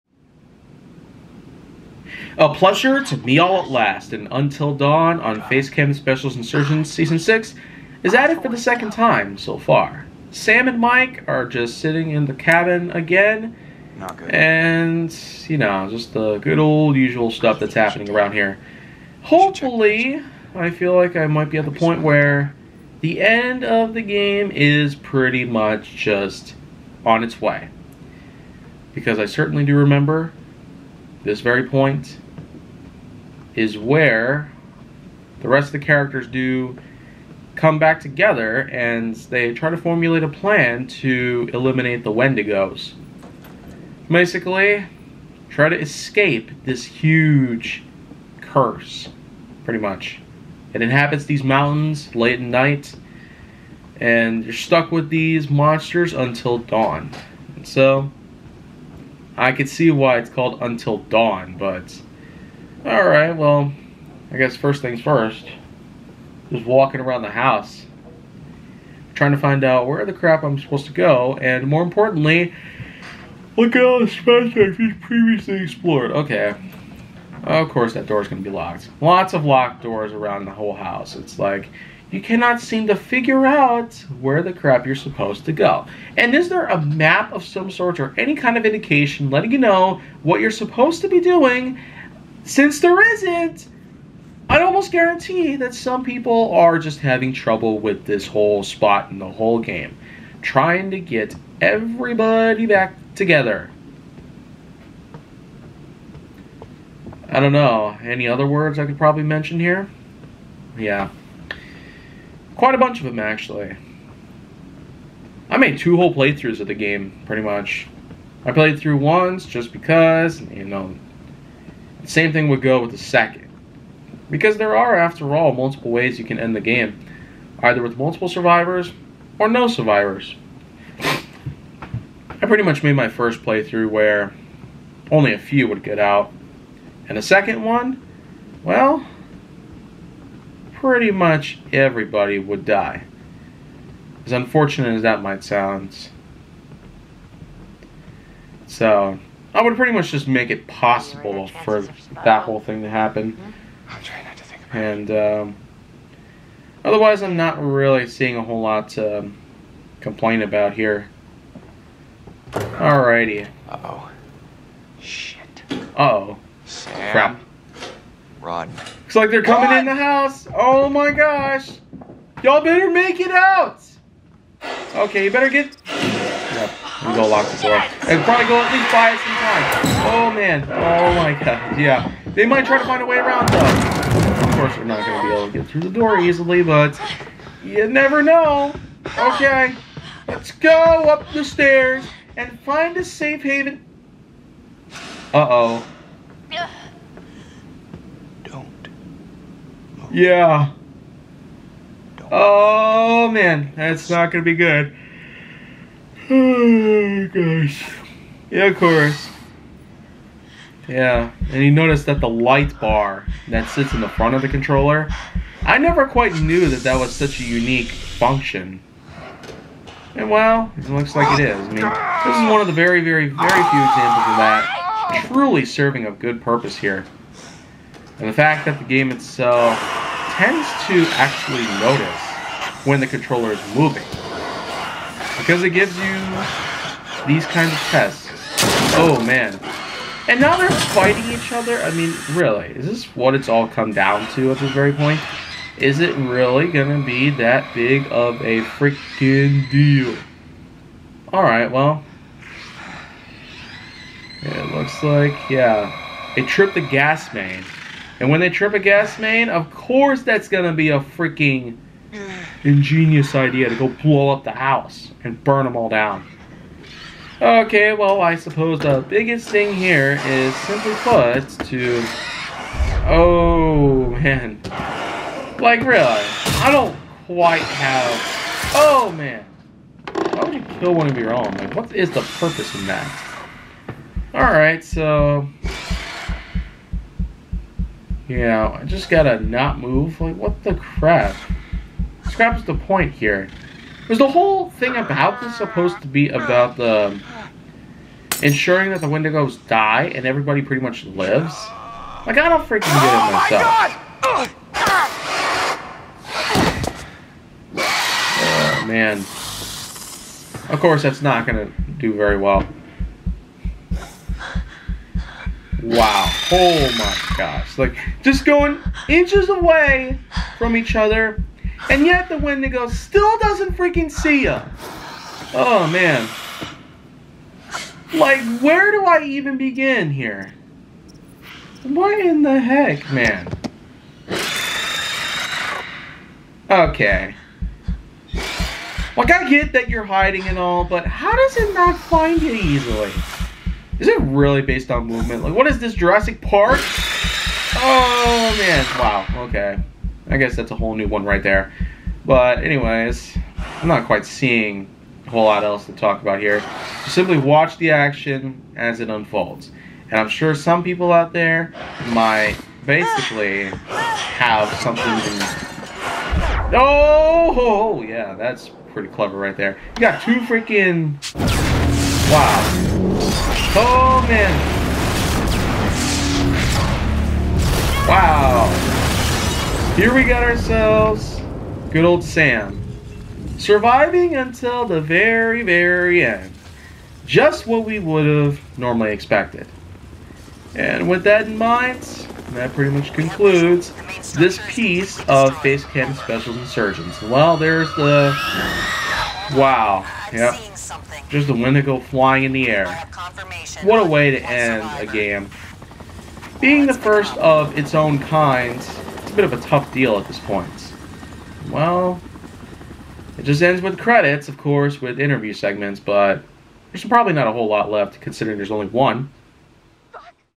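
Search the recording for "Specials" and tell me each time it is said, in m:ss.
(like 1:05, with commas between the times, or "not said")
0:05, 6:36.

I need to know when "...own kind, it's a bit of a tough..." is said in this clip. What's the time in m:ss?
6:47.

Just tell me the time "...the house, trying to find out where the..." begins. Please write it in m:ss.
1:07.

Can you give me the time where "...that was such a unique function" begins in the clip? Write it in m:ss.
3:36.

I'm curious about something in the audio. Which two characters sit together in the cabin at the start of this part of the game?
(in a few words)
Sam and Mike.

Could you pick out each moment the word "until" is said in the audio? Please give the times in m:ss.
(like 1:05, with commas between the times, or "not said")
0:04, 0:56, 1:00, 6:24.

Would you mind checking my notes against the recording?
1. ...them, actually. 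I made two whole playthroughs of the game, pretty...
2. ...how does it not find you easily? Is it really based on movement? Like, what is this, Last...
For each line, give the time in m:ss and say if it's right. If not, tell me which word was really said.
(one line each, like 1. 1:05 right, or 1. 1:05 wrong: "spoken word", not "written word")
1. 1:53 right
2. 5:41 wrong: "Jurassic", not "Last".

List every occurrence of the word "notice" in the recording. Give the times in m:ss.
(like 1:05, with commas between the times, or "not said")
3:31, 3:51.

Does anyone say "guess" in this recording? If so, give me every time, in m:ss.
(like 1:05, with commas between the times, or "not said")
1:04, 5:50.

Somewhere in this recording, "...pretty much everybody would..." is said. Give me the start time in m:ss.
2:20.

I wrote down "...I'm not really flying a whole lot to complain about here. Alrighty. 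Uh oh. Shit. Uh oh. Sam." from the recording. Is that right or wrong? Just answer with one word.
wrong.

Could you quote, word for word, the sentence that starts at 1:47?
I don't know, any other words I could probably mention here?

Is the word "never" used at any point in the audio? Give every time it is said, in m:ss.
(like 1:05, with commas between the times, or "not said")
3:07, 3:35.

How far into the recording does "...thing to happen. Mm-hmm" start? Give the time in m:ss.
2:32.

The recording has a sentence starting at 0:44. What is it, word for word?
Basically, try to escape this huge curse, pretty much.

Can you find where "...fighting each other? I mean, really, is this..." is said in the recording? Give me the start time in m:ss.
4:00.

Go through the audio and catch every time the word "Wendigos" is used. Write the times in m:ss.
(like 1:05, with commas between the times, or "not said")
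0:42, 4:59, 5:22, 6:41.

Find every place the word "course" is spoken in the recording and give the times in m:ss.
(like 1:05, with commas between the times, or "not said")
1:17, 3:04, 3:28, 4:19, 5:10, 6:54.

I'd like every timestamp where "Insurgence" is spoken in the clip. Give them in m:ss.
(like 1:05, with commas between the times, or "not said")
0:06, 6:36.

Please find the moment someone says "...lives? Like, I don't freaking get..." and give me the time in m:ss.
5:01.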